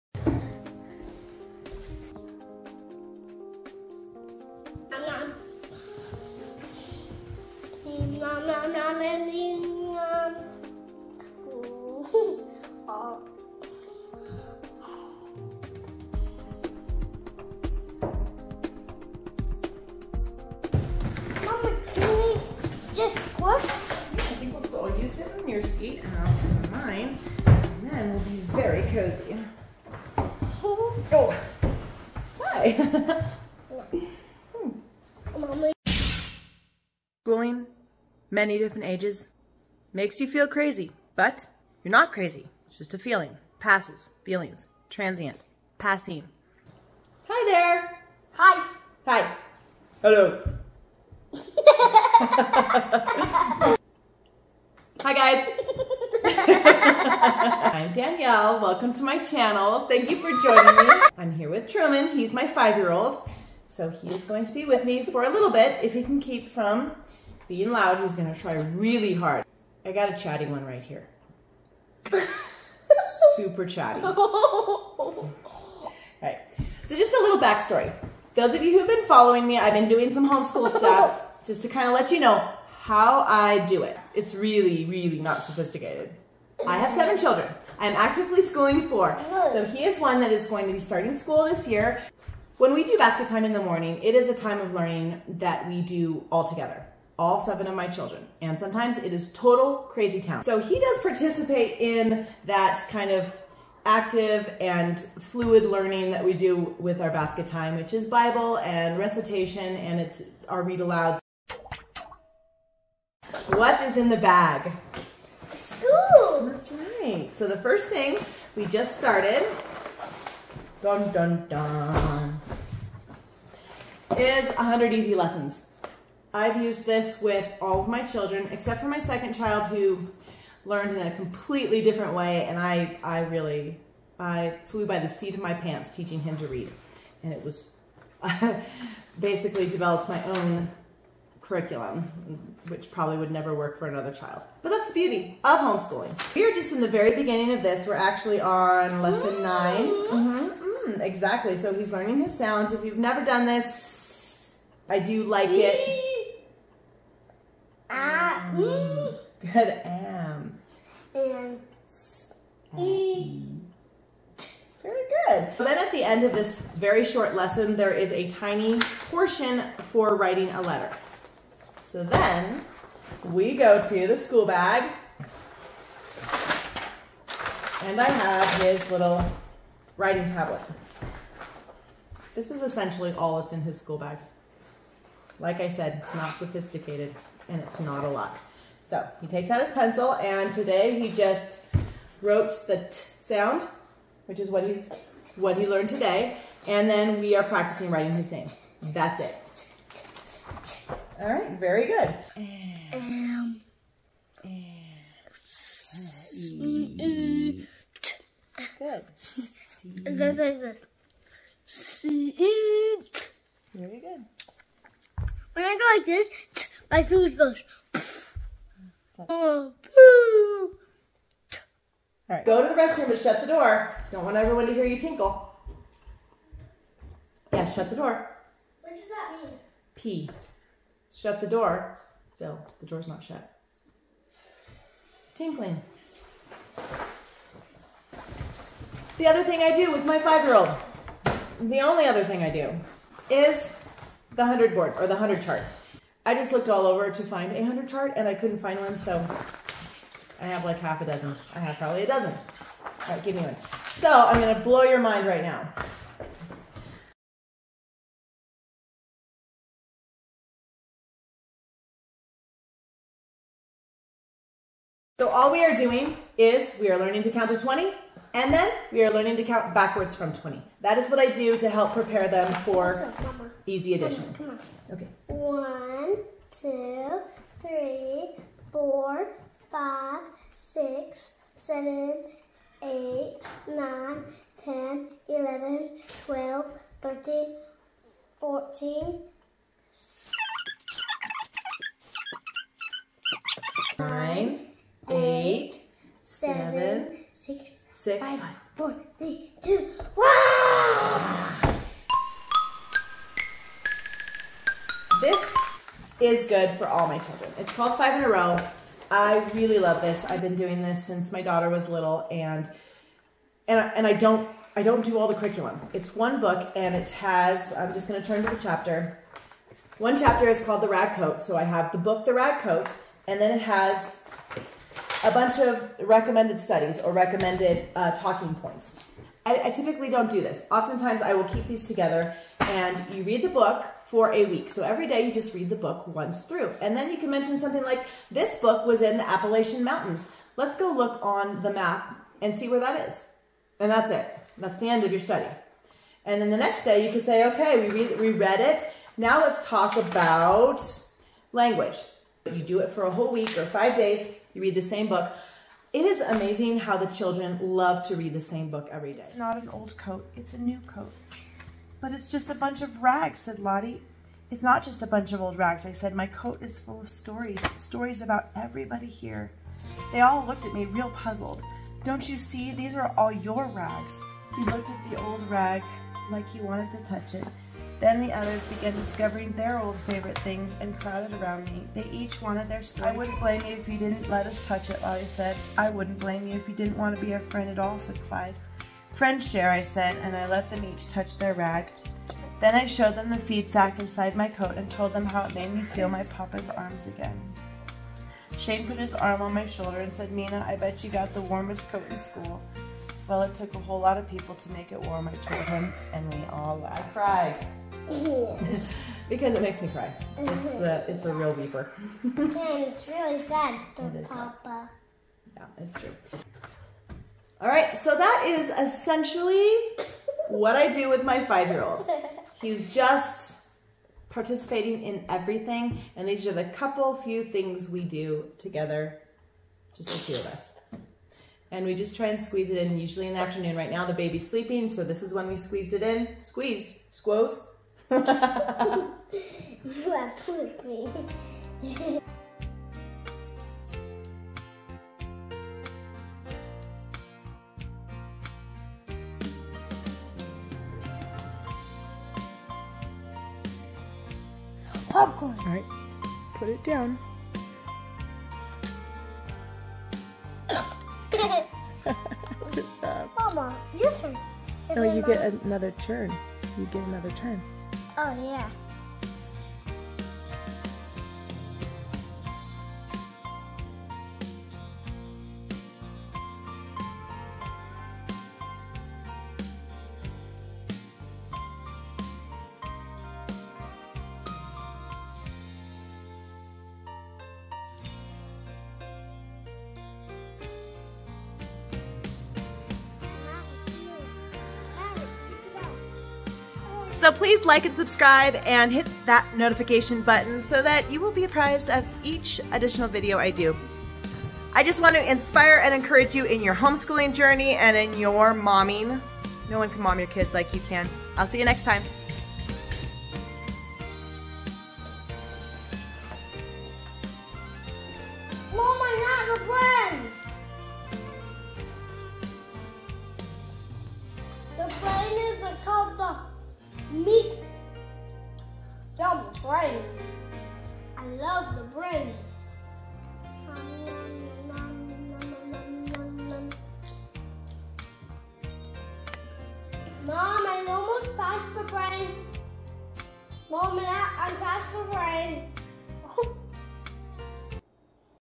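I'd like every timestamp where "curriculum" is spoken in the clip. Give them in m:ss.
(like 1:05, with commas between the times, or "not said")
2:21, 5:15.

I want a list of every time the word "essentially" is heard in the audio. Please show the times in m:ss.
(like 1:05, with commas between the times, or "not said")
3:02, 6:58.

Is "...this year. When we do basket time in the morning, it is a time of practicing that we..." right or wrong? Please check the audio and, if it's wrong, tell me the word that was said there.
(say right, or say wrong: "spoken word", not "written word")
wrong: "learning", not "practicing".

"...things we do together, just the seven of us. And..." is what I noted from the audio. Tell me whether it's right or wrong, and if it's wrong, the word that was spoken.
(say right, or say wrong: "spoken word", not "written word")
wrong: "two", not "seven".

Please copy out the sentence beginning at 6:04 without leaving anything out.
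It's not just a bunch of old rags, I said.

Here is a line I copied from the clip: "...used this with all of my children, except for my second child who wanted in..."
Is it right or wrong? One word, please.
wrong.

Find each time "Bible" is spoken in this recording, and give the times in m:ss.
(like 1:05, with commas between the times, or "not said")
1:48.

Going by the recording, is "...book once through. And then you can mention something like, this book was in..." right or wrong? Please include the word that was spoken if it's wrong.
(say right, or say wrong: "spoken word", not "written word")
right.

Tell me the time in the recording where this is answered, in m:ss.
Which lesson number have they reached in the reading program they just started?
2:29.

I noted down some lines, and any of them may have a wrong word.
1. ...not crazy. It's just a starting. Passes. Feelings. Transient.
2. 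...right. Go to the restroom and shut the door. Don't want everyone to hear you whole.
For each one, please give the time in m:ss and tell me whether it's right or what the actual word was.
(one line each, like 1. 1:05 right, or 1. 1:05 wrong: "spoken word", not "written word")
1. 0:41 wrong: "feeling", not "starting"
2. 3:42 wrong: "tinkle", not "whole".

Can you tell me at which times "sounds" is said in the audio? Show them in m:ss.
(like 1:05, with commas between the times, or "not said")
2:32, 3:12.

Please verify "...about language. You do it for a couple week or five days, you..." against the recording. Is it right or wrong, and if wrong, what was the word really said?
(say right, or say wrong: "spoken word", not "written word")
wrong: "whole", not "couple".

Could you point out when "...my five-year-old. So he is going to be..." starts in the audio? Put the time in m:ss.
1:02.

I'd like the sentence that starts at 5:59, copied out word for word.
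It's not an old coat, it's a new coat.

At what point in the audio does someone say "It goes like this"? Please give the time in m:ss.
3:30.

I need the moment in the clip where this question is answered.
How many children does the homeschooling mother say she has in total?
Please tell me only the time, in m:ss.
1:26.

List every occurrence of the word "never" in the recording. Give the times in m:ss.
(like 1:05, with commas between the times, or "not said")
2:23, 2:33.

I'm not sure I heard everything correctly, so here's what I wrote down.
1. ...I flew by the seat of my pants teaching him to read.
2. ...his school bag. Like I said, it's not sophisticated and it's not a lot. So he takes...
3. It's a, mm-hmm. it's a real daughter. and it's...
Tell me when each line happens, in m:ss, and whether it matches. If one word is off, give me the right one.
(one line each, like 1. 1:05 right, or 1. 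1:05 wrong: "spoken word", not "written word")
1. 2:14 right
2. 3:03 right
3. 6:50 wrong: "weeper", not "daughter".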